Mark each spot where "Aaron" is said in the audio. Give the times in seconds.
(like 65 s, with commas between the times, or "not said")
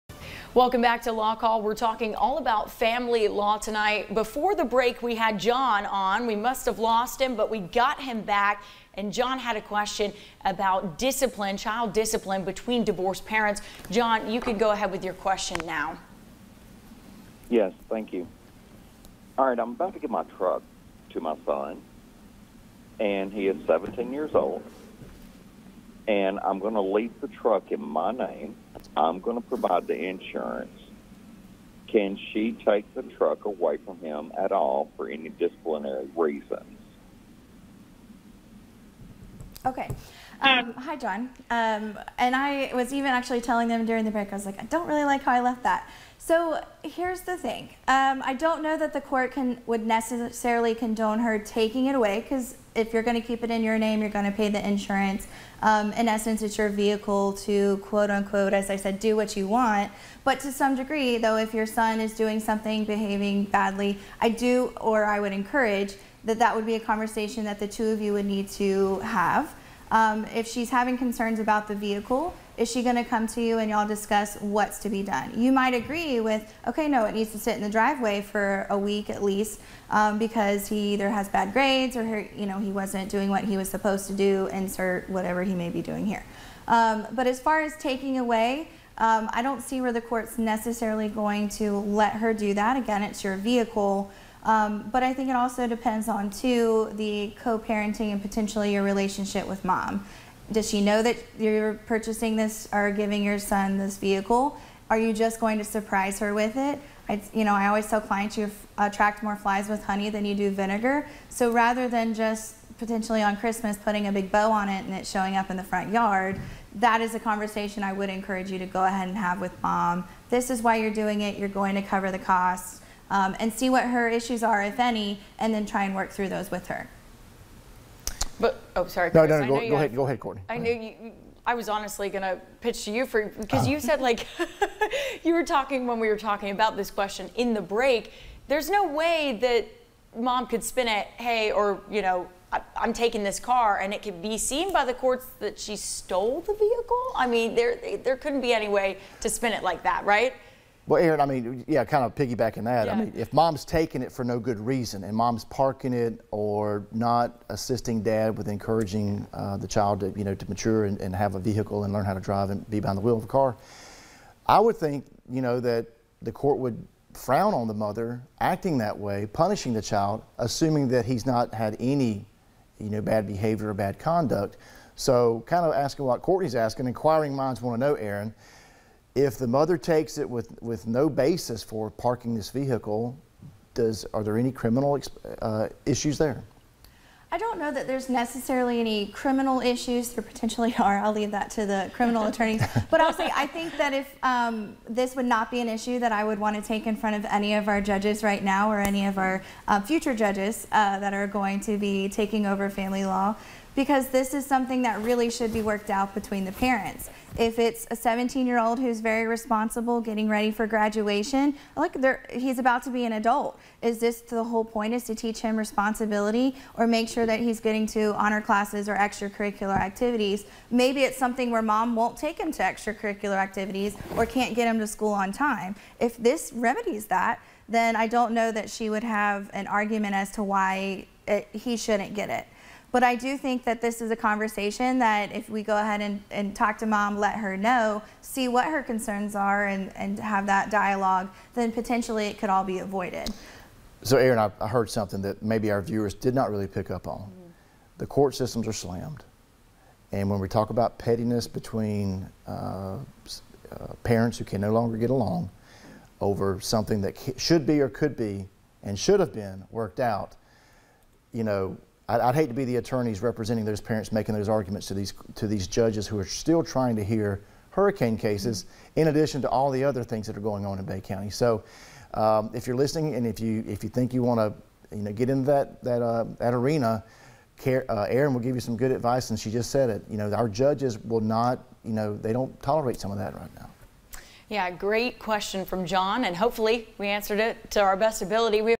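151 s, 177 s, 244 s, 278 s.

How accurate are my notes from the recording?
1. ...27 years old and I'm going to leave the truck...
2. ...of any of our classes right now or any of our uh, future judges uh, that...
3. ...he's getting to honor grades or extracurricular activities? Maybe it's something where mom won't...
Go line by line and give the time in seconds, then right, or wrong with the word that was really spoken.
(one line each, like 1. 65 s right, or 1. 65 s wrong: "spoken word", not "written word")
1. 23 s wrong: "17", not "27"
2. 197 s wrong: "judges", not "classes"
3. 217 s wrong: "classes", not "grades".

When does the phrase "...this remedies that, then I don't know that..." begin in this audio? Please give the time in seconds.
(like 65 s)
226 s.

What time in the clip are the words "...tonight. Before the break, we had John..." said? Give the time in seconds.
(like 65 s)
3 s.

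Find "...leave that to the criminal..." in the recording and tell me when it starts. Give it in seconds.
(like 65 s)
191 s.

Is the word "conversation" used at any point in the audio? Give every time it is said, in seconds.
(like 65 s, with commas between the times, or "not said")
66 s, 117 s, 234 s.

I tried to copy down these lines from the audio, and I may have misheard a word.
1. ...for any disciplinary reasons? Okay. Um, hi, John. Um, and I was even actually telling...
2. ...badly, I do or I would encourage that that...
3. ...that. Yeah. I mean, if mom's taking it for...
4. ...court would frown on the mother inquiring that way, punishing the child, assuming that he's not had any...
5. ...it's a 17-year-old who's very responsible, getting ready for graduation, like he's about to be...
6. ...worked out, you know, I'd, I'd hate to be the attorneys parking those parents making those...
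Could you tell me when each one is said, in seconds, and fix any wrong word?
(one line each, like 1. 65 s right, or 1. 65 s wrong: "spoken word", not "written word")
1. 34 s right
2. 63 s right
3. 152 s right
4. 166 s wrong: "acting", not "inquiring"
5. 207 s right
6. 259 s wrong: "representing", not "parking".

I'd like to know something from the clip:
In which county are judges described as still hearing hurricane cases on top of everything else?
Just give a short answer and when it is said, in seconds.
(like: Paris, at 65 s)
Bay County, at 270 s.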